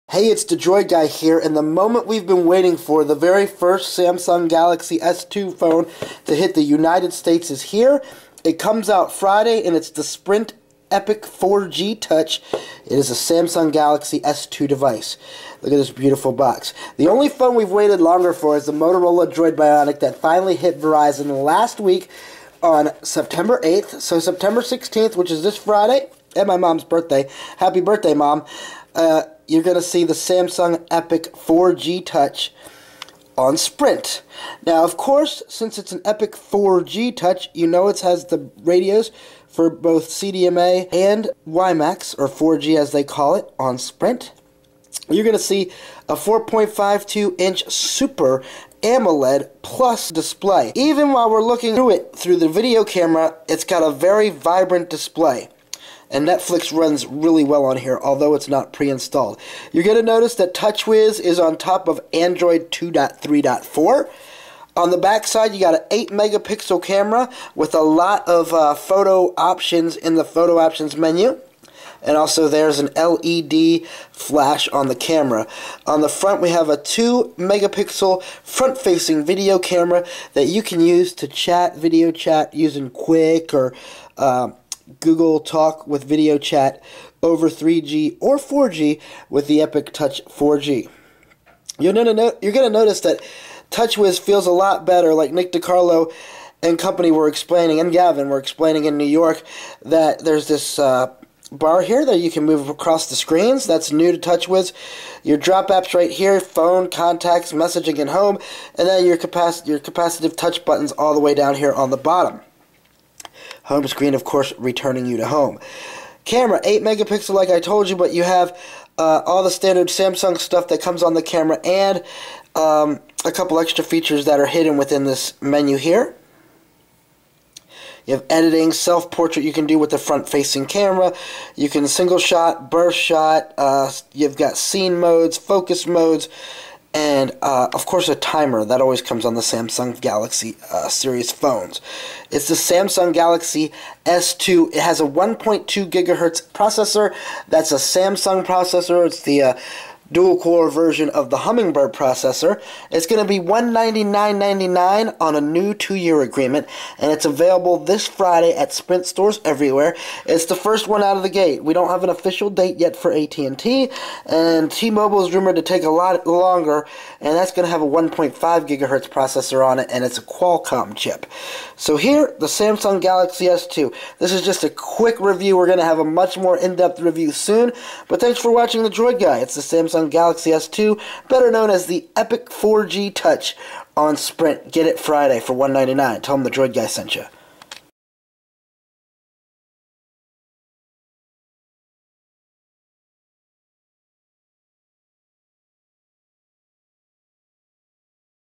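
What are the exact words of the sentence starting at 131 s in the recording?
You can single shot, burst shot.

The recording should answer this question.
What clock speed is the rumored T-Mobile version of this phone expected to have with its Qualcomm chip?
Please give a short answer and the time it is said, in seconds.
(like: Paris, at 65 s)
1.5 gigahertz, at 167 s.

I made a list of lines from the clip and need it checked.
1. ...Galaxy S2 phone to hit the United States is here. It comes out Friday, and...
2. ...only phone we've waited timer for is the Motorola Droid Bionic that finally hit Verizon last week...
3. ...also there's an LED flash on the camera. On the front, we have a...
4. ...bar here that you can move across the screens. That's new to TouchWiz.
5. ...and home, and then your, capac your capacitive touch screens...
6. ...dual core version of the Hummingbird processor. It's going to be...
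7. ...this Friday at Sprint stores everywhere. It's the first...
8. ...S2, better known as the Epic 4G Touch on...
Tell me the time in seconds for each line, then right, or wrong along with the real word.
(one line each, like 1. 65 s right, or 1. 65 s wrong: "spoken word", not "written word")
1. 4 s right
2. 17 s wrong: "longer", not "timer"
3. 72 s right
4. 101 s right
5. 107 s wrong: "buttons", not "screens"
6. 150 s right
7. 157 s right
8. 180 s right.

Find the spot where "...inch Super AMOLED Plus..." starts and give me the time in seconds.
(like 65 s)
47 s.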